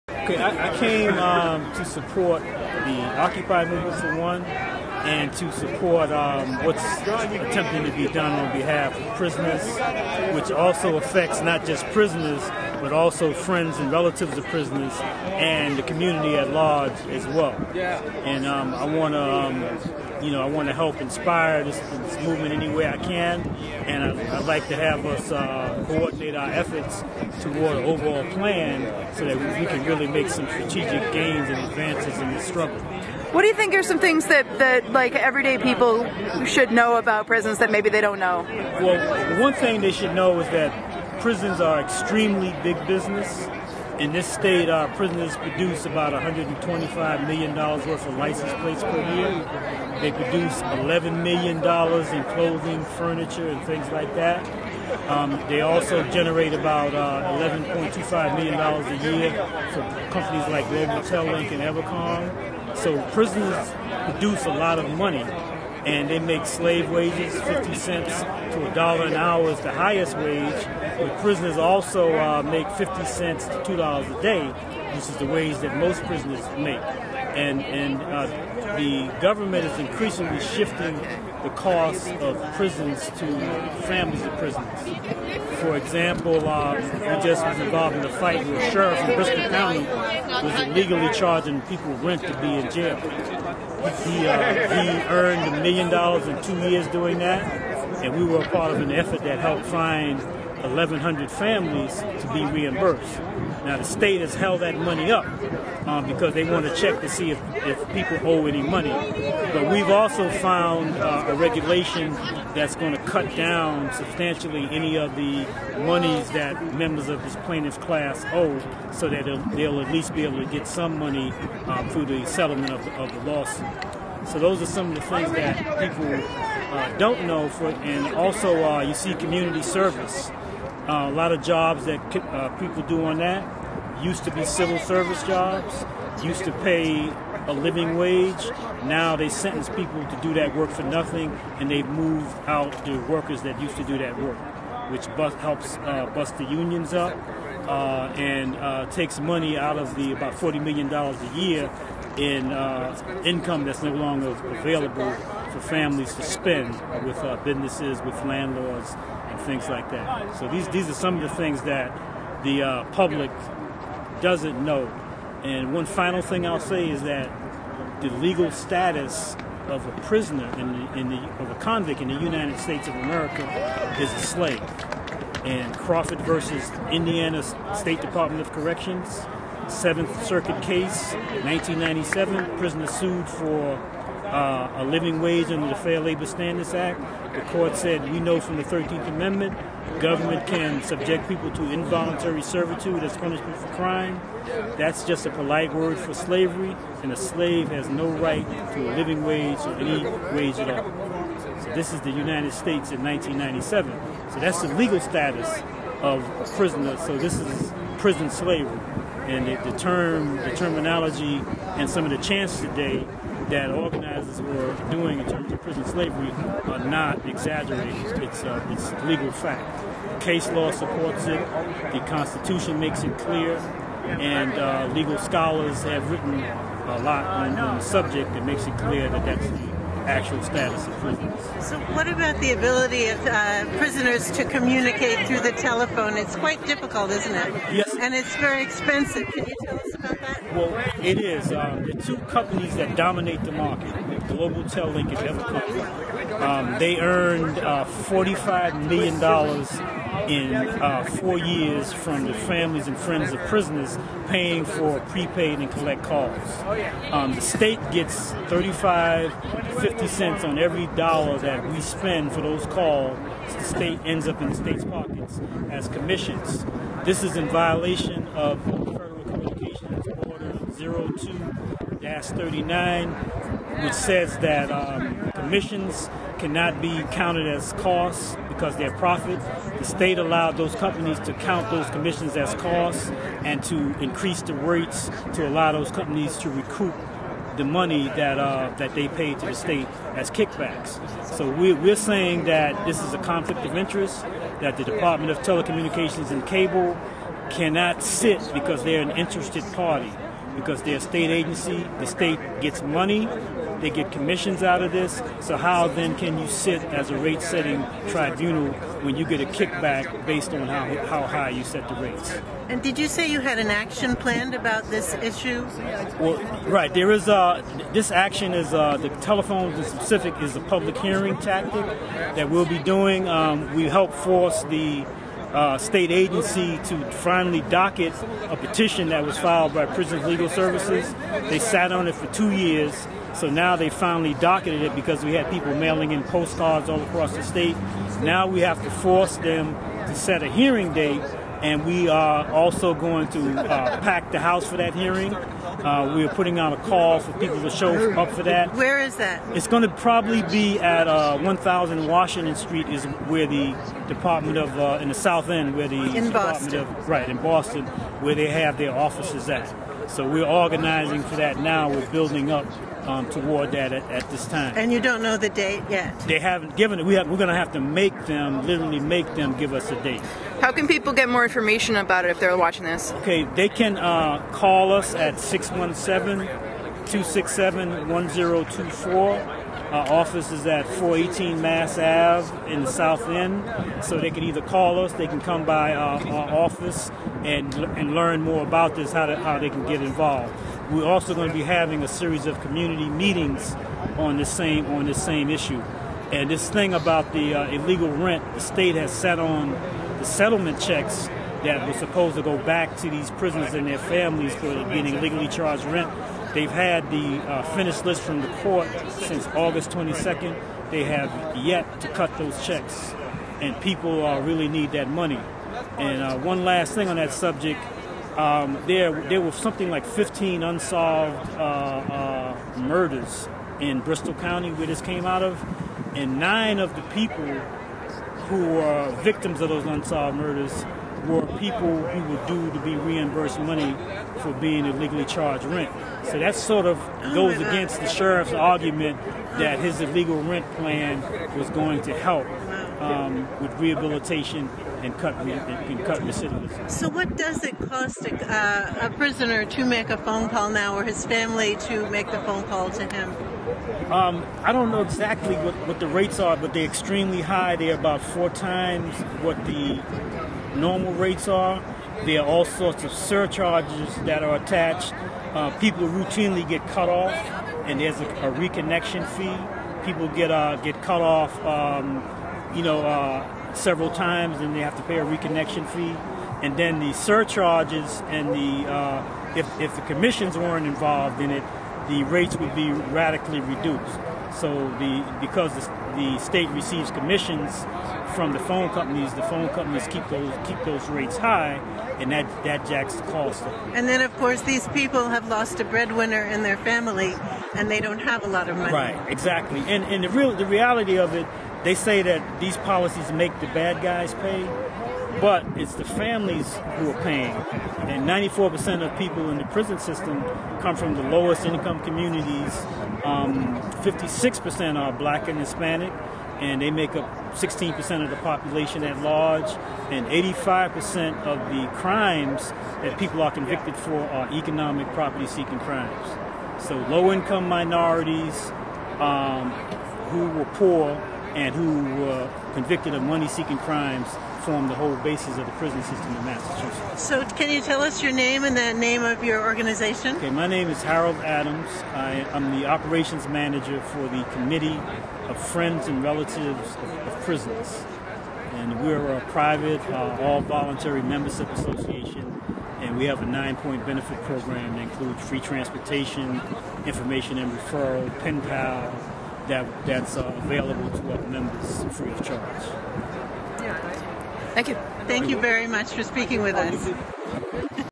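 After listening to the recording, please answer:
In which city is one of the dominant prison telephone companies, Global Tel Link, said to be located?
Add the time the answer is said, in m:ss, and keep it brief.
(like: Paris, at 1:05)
Albuquerque, at 4:05.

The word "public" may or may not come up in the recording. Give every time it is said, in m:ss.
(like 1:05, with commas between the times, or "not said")
2:42, 5:20.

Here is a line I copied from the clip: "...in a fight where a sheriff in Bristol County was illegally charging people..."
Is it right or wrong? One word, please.
right.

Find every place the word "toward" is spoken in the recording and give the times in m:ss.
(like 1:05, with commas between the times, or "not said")
0:27, 6:03.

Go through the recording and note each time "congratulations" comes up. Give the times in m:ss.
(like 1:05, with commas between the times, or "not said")
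not said.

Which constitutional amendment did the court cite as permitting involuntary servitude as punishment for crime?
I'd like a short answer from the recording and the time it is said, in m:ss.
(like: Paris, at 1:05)
13th Amendment, at 3:08.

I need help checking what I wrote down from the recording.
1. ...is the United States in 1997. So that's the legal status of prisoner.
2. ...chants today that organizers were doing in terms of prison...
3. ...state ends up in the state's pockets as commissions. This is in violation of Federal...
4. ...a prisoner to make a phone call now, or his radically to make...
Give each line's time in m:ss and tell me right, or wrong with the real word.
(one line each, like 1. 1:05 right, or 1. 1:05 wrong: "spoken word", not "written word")
1. 3:21 right
2. 3:32 right
3. 4:23 right
4. 7:29 wrong: "family", not "radically".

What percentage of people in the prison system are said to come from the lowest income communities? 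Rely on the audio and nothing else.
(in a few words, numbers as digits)
94%.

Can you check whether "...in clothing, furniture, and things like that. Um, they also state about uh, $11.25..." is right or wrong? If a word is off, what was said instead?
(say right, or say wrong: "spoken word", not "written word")
wrong: "generate", not "state".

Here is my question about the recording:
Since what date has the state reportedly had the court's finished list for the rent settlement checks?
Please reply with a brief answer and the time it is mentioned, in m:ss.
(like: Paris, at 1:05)
August 22, at 6:49.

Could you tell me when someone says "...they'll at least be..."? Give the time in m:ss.
1:59.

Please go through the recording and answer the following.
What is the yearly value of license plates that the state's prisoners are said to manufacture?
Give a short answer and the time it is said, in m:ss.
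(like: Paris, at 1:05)
$125 million, at 0:46.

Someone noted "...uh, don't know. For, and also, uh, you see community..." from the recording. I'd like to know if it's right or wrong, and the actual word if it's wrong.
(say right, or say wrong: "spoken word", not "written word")
right.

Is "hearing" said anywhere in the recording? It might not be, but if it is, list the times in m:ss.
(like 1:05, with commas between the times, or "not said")
5:20, 5:40, 5:44.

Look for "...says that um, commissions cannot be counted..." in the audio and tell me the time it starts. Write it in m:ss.
4:33.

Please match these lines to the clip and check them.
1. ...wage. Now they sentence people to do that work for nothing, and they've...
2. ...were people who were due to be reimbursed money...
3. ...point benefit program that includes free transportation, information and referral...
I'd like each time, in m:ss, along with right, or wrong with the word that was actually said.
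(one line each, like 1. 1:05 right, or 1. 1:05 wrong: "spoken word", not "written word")
1. 2:17 right
2. 7:11 right
3. 9:13 right.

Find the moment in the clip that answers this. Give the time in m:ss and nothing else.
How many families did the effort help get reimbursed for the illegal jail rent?
1:40.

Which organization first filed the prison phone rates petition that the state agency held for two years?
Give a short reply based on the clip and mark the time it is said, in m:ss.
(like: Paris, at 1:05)
Prisons Legal Services, at 5:29.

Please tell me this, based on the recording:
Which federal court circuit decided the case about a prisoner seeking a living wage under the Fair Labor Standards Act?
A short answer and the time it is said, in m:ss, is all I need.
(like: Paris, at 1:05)
Seventh Circuit, at 2:59.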